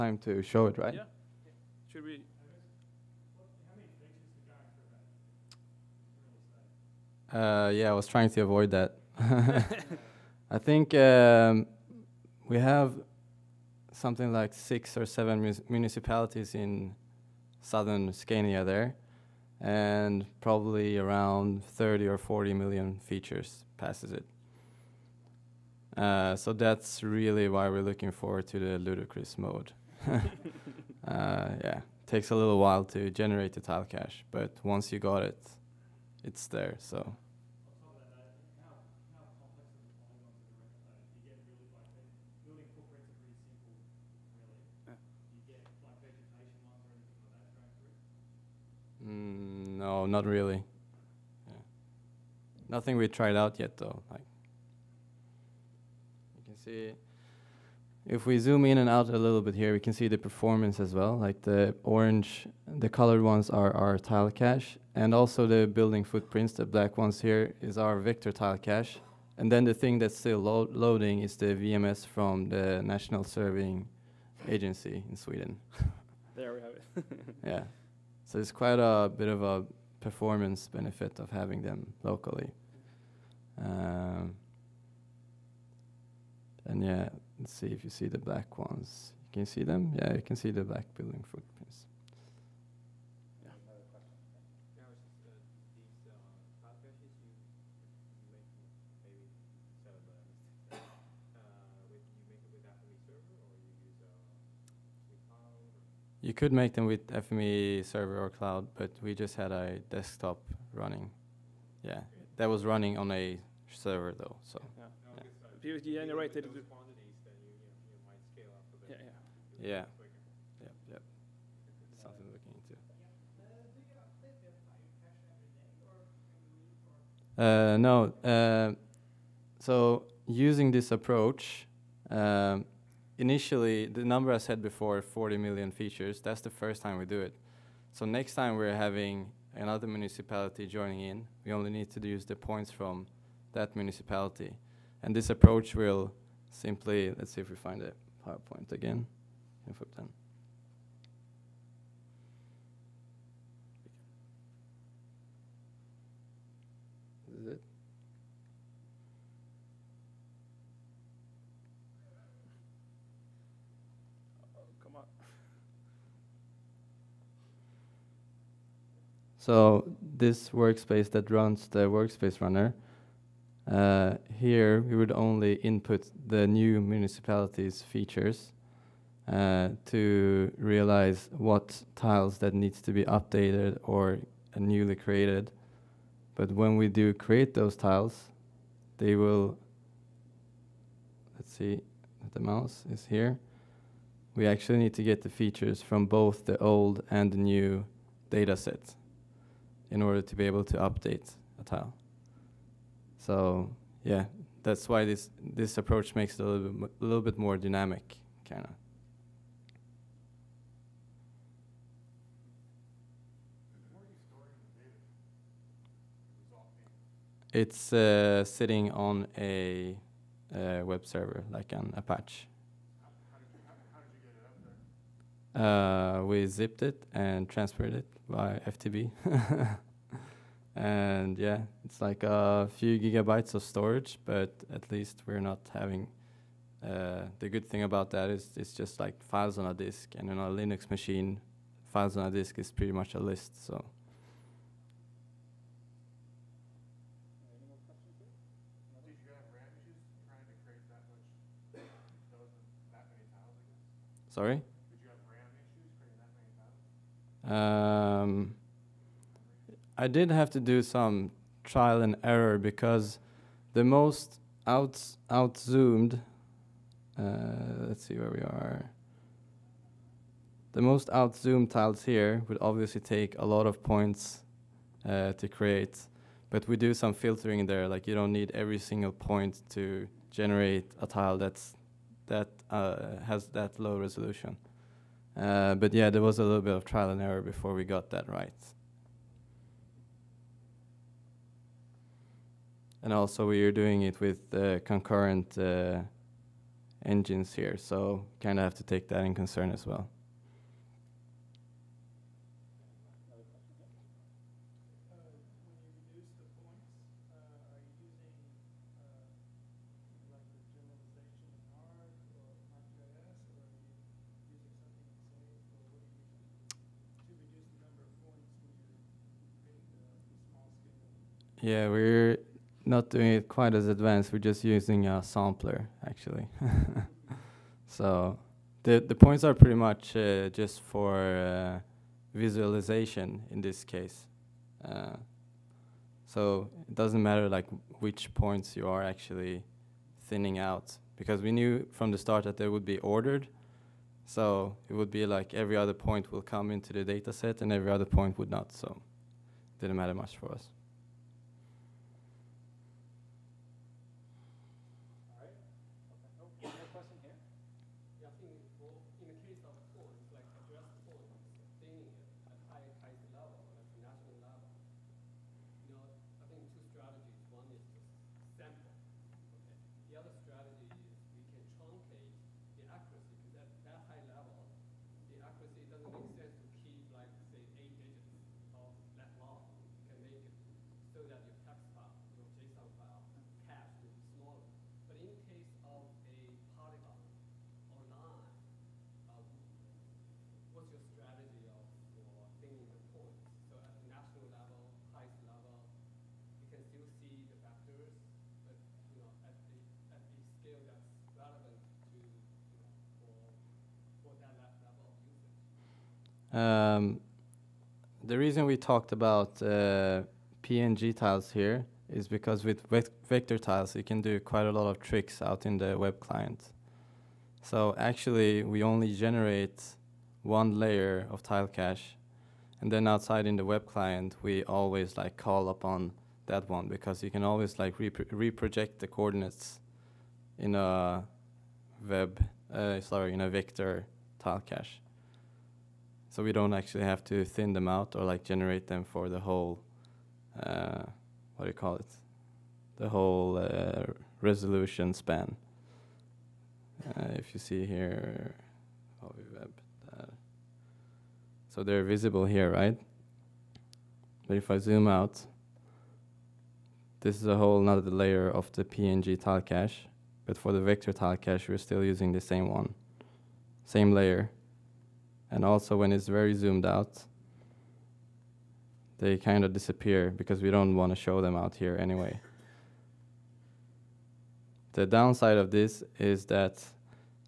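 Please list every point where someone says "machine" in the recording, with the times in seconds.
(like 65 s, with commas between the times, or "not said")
240 s.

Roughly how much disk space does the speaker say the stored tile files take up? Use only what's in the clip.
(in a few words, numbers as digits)
A few gigabytes.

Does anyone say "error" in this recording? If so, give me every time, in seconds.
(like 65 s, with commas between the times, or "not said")
262 s, 287 s.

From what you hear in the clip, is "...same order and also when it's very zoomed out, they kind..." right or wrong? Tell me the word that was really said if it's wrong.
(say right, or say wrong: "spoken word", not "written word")
wrong: "layer", not "order".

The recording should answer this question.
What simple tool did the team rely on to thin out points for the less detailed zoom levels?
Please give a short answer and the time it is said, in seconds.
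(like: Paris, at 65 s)
A sampler, at 325 s.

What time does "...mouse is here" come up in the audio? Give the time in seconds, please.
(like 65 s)
192 s.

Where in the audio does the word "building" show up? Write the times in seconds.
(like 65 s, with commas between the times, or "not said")
65 s, 90 s.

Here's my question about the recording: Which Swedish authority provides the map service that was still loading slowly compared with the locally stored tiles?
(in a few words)
National Surveying Agency.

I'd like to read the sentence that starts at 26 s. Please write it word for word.
Uh, so that's really why we're looking forward to the ludicrous mode.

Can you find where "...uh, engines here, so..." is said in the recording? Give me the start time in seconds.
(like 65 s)
295 s.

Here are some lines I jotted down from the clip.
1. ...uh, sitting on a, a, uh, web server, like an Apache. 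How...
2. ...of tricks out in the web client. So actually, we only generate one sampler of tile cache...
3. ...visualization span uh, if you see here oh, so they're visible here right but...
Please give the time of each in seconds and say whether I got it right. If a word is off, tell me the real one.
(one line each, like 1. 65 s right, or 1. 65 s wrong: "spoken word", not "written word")
1. 217 s right
2. 414 s wrong: "layer", not "sampler"
3. 444 s wrong: "resolution", not "visualization".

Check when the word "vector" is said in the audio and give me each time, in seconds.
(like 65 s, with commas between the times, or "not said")
67 s, 413 s, 433 s, 460 s.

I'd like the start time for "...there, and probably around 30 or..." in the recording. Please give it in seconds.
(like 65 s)
18 s.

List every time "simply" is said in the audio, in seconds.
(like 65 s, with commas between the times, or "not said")
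146 s.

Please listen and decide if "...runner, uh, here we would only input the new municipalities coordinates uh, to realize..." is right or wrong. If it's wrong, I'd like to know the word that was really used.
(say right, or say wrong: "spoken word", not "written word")
wrong: "features", not "coordinates".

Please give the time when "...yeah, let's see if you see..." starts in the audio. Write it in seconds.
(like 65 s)
86 s.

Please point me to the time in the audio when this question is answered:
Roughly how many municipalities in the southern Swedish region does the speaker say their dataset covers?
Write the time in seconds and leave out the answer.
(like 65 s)
14 s.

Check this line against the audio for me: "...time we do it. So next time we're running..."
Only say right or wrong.
wrong.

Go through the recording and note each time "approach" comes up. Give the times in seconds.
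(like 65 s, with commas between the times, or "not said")
130 s, 145 s, 205 s.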